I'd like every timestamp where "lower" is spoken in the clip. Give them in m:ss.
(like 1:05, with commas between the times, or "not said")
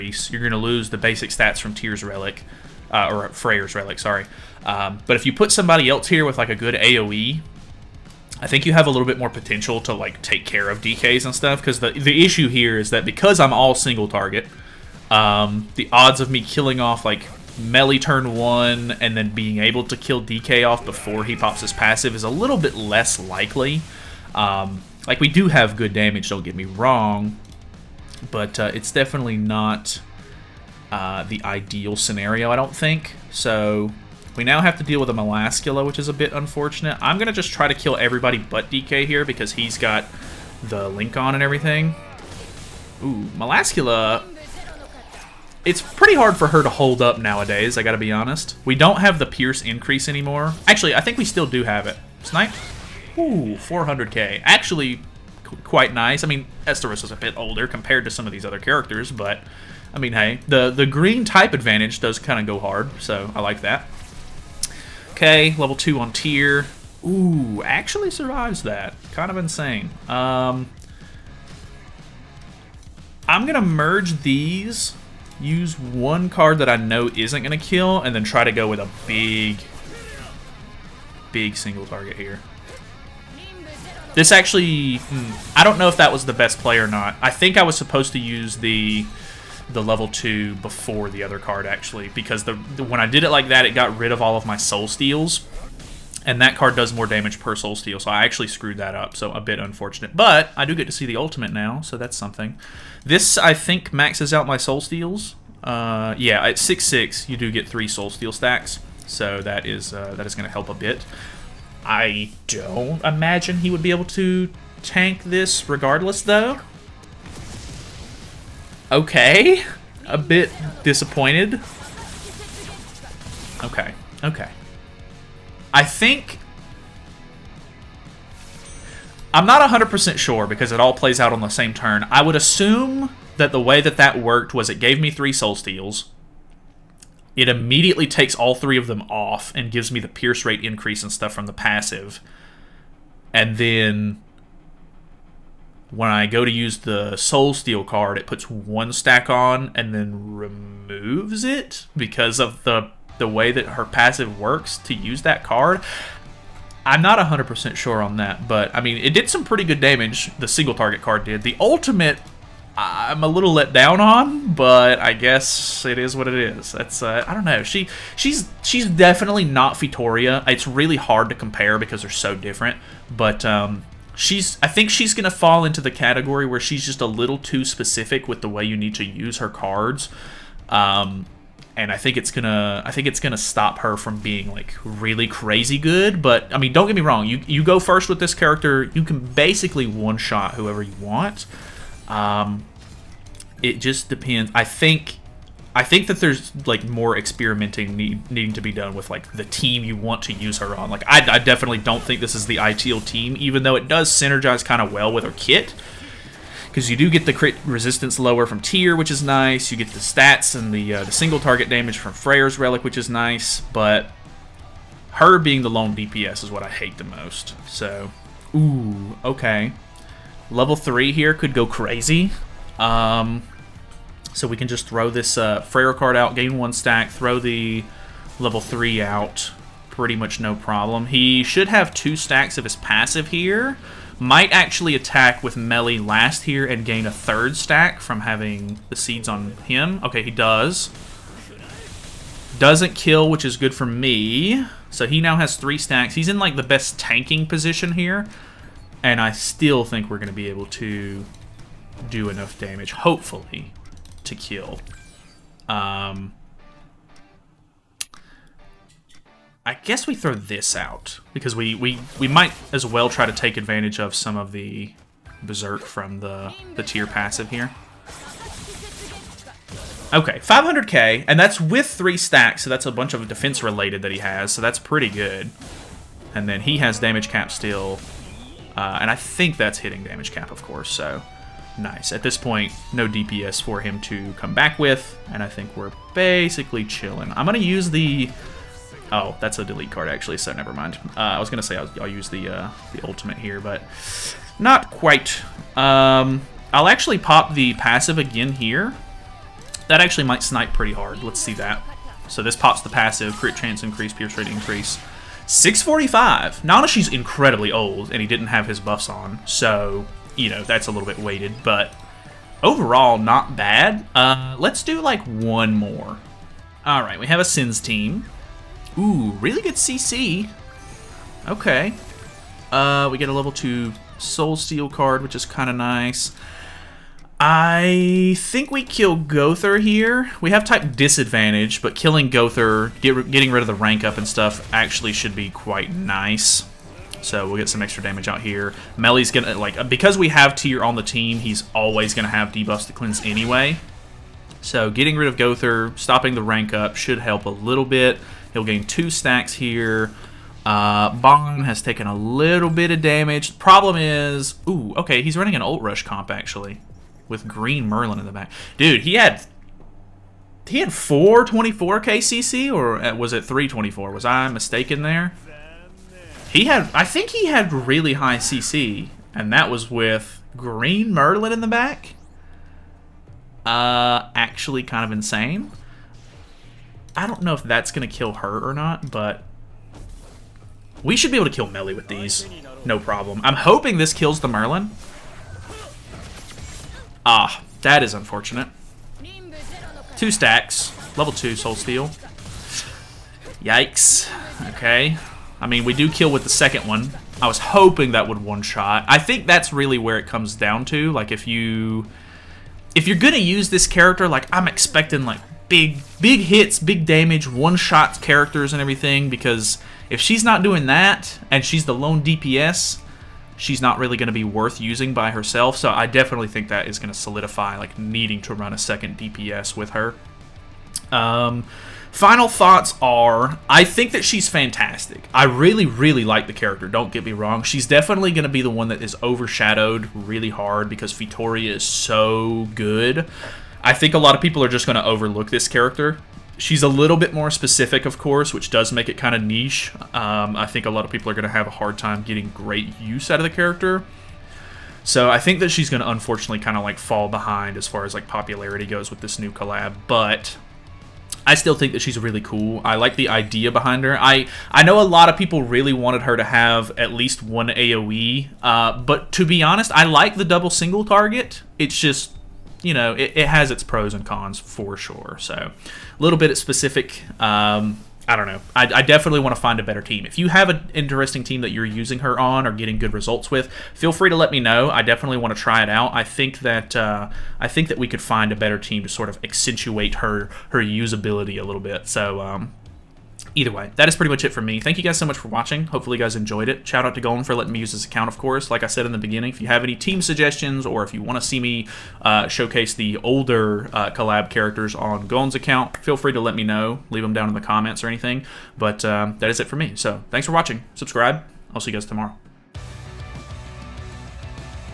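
3:28.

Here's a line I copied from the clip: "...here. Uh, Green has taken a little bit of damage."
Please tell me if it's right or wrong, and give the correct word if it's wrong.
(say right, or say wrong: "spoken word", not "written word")
wrong: "Bong", not "Green".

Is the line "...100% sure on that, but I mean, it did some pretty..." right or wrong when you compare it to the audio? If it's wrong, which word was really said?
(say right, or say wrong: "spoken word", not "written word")
right.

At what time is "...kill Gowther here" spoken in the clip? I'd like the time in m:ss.
5:28.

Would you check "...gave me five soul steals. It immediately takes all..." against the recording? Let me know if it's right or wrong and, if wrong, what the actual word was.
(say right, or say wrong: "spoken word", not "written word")
wrong: "three", not "five".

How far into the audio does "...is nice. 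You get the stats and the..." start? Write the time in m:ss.
3:29.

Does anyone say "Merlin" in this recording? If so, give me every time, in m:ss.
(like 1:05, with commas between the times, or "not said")
5:57, 6:11, 6:24.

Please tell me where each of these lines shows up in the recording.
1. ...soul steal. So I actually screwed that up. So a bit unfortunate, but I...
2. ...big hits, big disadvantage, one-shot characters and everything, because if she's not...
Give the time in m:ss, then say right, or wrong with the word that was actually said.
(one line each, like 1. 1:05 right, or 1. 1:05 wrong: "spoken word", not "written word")
1. 1:37 right
2. 6:46 wrong: "damage", not "disadvantage".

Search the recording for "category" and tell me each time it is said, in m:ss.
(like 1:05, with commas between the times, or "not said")
2:55.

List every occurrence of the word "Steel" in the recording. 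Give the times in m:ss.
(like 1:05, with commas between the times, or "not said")
2:27, 5:24, 6:31.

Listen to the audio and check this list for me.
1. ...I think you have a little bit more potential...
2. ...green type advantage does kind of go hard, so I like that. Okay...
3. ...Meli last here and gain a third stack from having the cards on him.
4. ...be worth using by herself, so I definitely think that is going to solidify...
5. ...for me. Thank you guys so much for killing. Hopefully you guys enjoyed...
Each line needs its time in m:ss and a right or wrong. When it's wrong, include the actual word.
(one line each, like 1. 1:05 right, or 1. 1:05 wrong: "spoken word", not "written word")
1. 0:08 right
2. 1:00 right
3. 3:55 wrong: "seeds", not "cards"
4. 6:54 right
5. 8:04 wrong: "watching", not "killing".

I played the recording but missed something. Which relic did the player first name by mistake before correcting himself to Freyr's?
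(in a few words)
Tyr's Relic.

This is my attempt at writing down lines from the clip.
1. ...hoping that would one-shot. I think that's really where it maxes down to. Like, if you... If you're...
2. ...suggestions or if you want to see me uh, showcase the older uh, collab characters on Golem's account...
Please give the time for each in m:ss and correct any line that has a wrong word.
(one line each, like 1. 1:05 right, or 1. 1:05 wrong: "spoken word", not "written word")
1. 6:37 wrong: "comes", not "maxes"
2. 8:10 right.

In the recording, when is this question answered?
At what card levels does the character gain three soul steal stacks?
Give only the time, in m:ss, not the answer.
1:46.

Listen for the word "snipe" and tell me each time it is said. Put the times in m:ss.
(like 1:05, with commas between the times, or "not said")
0:52, 5:00.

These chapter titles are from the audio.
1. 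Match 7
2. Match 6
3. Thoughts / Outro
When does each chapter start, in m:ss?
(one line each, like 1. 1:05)
1. 5:16
2. 3:03
3. 6:42.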